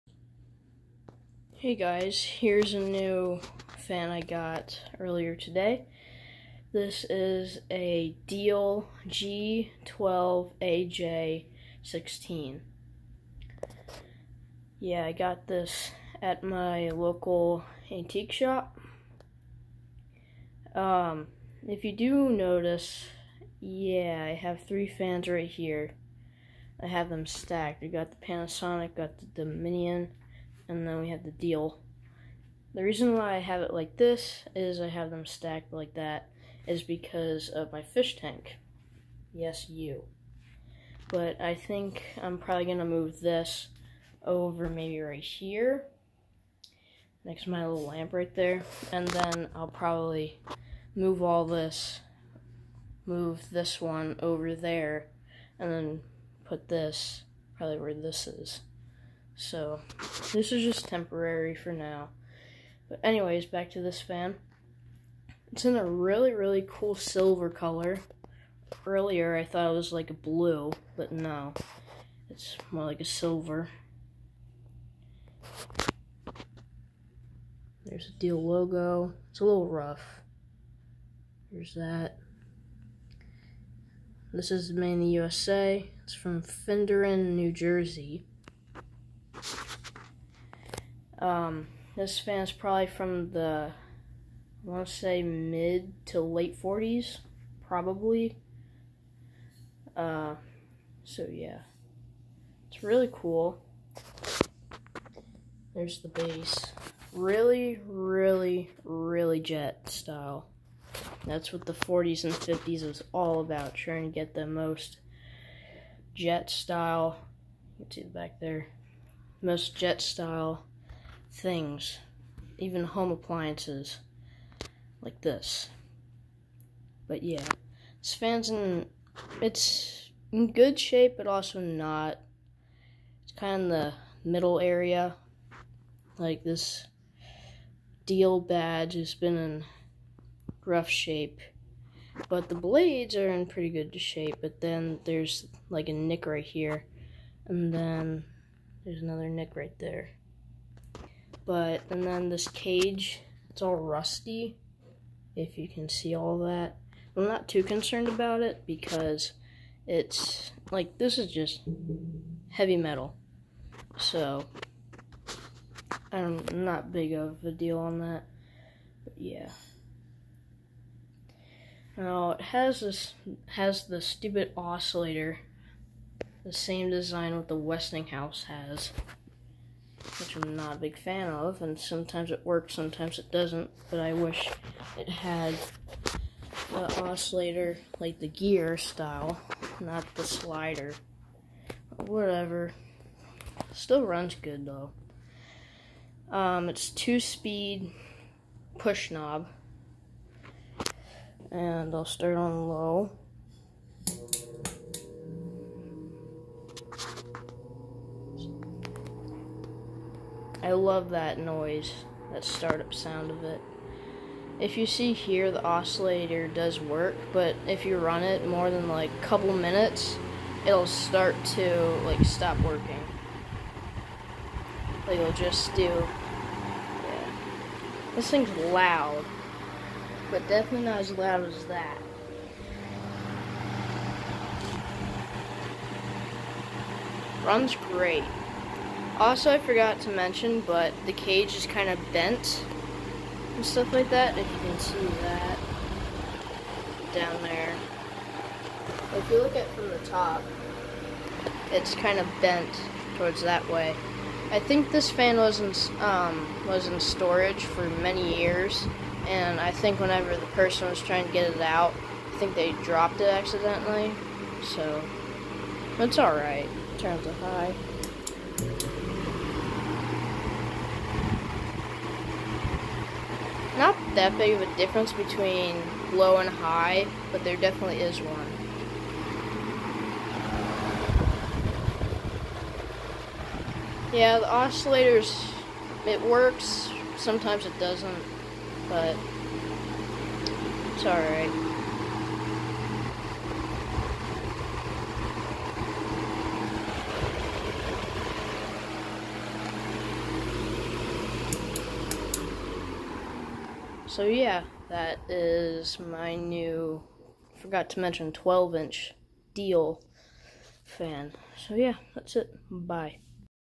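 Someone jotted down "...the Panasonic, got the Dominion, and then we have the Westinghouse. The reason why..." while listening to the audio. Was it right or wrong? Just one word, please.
wrong.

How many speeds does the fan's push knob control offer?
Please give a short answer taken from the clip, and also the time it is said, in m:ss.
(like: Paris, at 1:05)
2, at 3:16.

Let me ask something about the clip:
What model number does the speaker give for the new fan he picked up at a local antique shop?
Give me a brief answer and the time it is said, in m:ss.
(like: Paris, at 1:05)
G12AJ16, at 0:09.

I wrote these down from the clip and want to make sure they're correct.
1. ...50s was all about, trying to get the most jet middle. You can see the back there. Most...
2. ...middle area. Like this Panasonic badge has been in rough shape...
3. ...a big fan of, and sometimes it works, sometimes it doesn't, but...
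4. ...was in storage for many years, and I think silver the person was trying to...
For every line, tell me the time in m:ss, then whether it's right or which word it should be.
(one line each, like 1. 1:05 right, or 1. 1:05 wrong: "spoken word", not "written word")
1. 1:52 wrong: "style", not "middle"
2. 2:14 wrong: "Diehl", not "Panasonic"
3. 3:00 right
4. 4:16 wrong: "whenever", not "silver".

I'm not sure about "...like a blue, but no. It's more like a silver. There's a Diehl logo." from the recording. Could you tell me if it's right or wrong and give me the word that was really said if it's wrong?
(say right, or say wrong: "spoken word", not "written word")
right.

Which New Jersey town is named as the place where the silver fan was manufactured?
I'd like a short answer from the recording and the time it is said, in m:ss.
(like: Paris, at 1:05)
Finderne, at 1:26.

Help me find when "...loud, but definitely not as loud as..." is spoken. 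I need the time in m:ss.
3:48.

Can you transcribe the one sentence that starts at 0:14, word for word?
Yeah, I got this at my local antique shop.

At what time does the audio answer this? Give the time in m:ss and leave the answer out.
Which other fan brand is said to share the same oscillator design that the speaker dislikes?
2:57.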